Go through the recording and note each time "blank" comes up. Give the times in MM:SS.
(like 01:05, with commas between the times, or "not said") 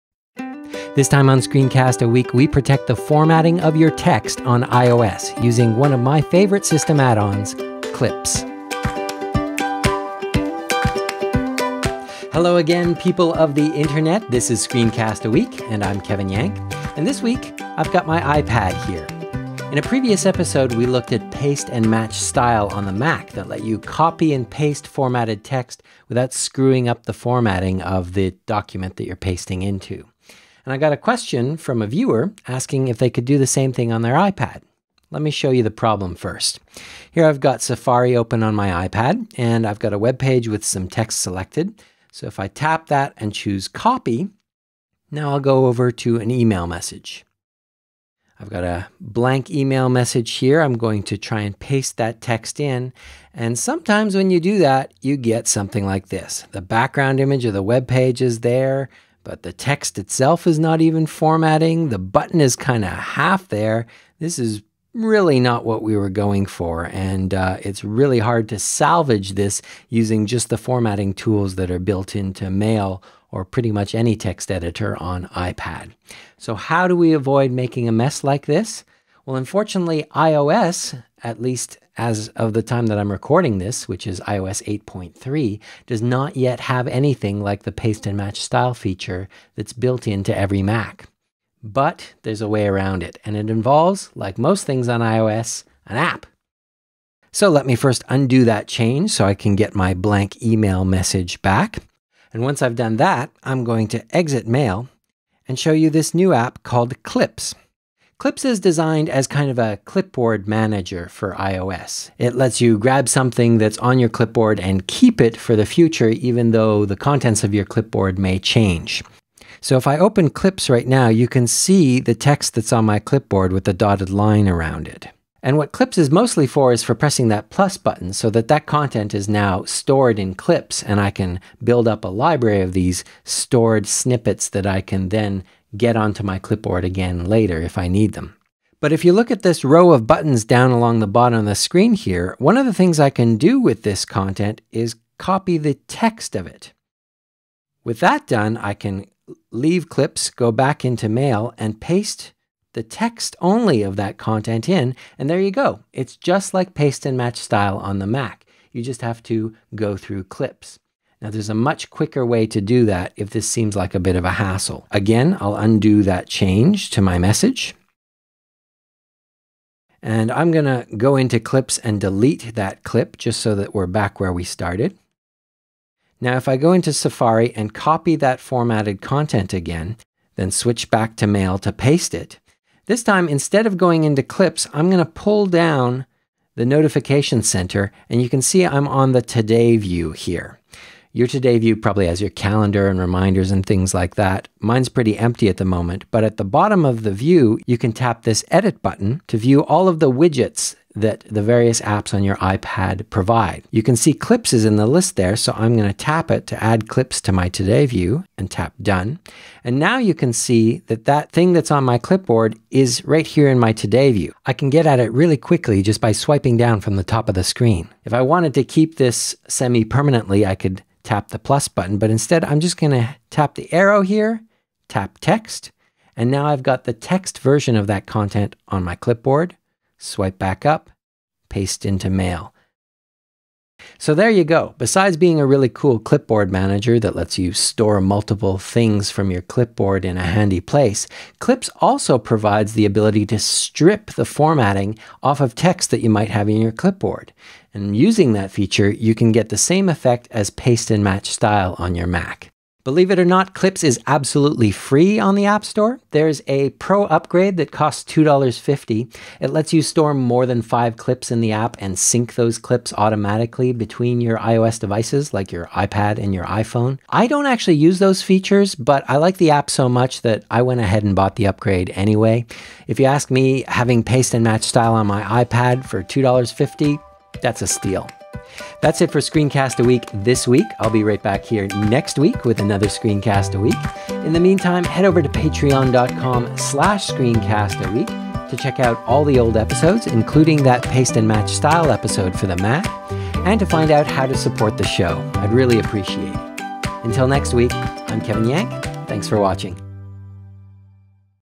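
00:48, 01:39.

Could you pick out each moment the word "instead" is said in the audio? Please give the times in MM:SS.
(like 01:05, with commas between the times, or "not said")
03:03, 03:42.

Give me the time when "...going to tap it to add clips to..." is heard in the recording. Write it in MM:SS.
03:25.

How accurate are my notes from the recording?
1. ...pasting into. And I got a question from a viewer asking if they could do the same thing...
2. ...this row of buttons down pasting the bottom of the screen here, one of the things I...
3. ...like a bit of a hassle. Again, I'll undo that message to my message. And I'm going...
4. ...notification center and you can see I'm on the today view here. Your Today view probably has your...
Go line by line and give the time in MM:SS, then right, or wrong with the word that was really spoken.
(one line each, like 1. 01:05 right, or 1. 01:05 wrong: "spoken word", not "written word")
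1. 00:29 right
2. 02:19 wrong: "along", not "pasting"
3. 02:43 wrong: "change", not "message"
4. 03:06 right.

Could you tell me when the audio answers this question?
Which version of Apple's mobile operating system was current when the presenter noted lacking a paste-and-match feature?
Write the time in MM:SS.
01:24.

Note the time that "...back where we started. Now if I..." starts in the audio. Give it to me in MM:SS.
02:53.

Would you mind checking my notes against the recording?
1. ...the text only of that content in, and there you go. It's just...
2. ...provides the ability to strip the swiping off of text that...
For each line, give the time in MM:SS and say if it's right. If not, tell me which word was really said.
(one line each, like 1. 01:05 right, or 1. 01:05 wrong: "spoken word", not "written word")
1. 02:32 right
2. 04:02 wrong: "formatting", not "swiping".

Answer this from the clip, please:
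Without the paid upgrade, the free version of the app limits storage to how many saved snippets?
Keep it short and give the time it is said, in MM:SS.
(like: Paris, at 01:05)
5, at 04:20.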